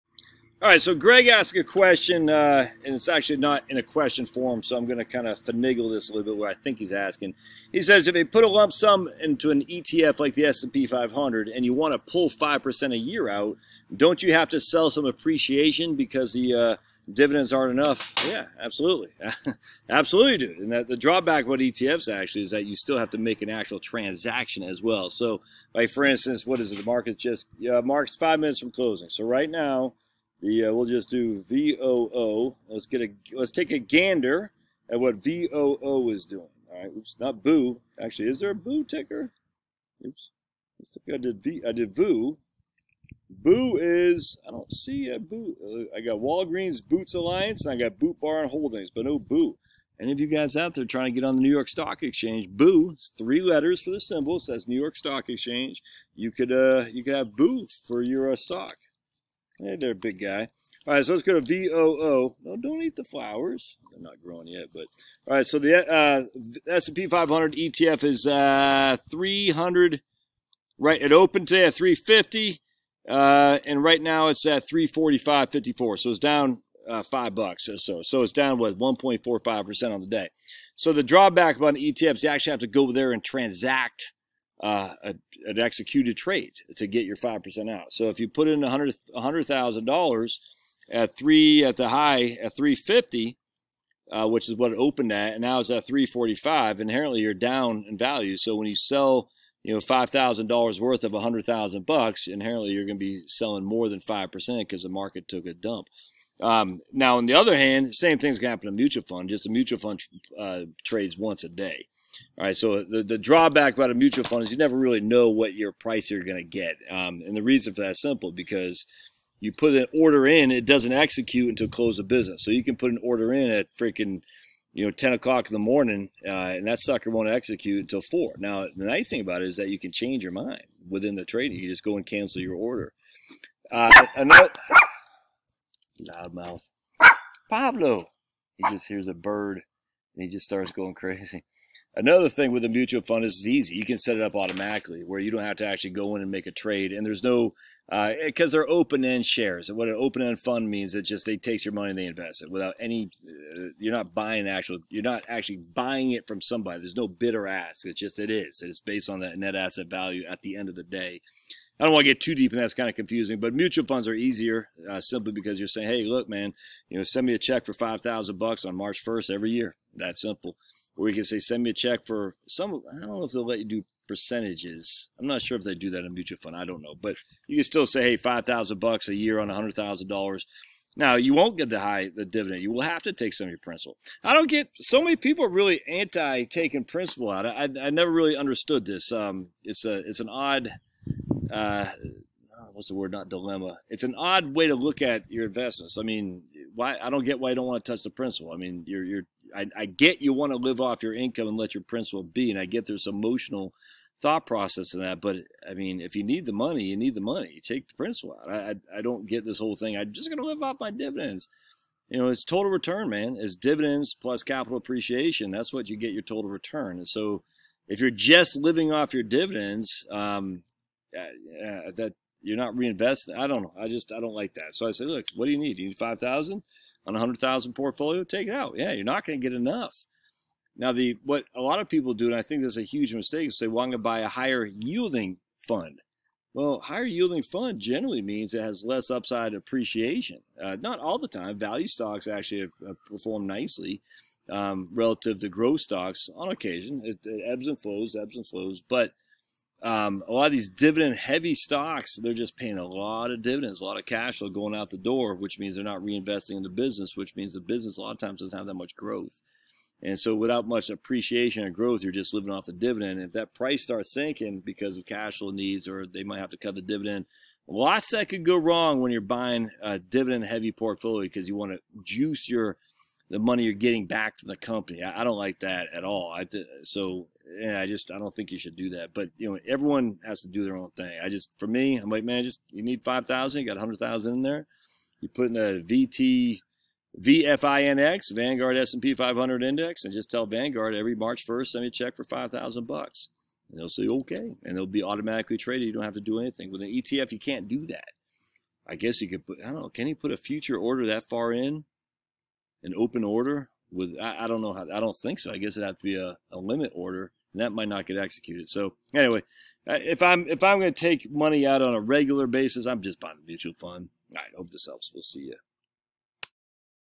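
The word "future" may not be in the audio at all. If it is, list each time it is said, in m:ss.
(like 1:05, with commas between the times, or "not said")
5:00.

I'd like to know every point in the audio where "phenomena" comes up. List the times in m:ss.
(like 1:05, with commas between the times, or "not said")
not said.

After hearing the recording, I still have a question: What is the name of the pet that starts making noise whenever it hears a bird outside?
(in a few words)
Pablo.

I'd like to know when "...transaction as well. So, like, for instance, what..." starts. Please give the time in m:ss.
0:23.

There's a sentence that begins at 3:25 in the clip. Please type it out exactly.
But I mean, if you need the money, you need the money.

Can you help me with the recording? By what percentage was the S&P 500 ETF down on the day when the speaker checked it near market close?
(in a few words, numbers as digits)
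1.45 percent.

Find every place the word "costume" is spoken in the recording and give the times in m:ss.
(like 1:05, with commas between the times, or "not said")
not said.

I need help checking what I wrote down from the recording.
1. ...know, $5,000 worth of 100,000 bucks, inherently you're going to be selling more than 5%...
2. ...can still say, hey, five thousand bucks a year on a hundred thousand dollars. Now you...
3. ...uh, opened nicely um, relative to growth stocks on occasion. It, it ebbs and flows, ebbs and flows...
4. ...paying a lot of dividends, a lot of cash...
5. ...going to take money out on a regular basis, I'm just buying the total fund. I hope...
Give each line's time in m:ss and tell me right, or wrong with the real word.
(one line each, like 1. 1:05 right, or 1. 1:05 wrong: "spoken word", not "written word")
1. 1:39 right
2. 2:57 right
3. 4:02 wrong: "performed", not "opened"
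4. 4:12 right
5. 5:10 wrong: "mutual", not "total".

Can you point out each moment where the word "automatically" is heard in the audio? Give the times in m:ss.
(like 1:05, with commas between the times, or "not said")
2:24, 4:55.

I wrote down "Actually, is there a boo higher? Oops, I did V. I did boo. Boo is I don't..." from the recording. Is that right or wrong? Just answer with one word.
wrong.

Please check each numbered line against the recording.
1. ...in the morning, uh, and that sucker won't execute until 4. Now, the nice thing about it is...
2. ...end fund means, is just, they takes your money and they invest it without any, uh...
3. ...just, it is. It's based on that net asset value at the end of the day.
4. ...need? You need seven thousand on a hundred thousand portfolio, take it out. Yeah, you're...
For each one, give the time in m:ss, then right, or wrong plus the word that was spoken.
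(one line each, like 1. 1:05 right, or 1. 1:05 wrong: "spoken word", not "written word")
1. 2:05 right
2. 2:30 right
3. 2:37 right
4. 3:45 wrong: "five", not "seven".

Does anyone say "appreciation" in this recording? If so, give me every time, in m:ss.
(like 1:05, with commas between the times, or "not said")
0:15, 3:34, 3:59, 4:20.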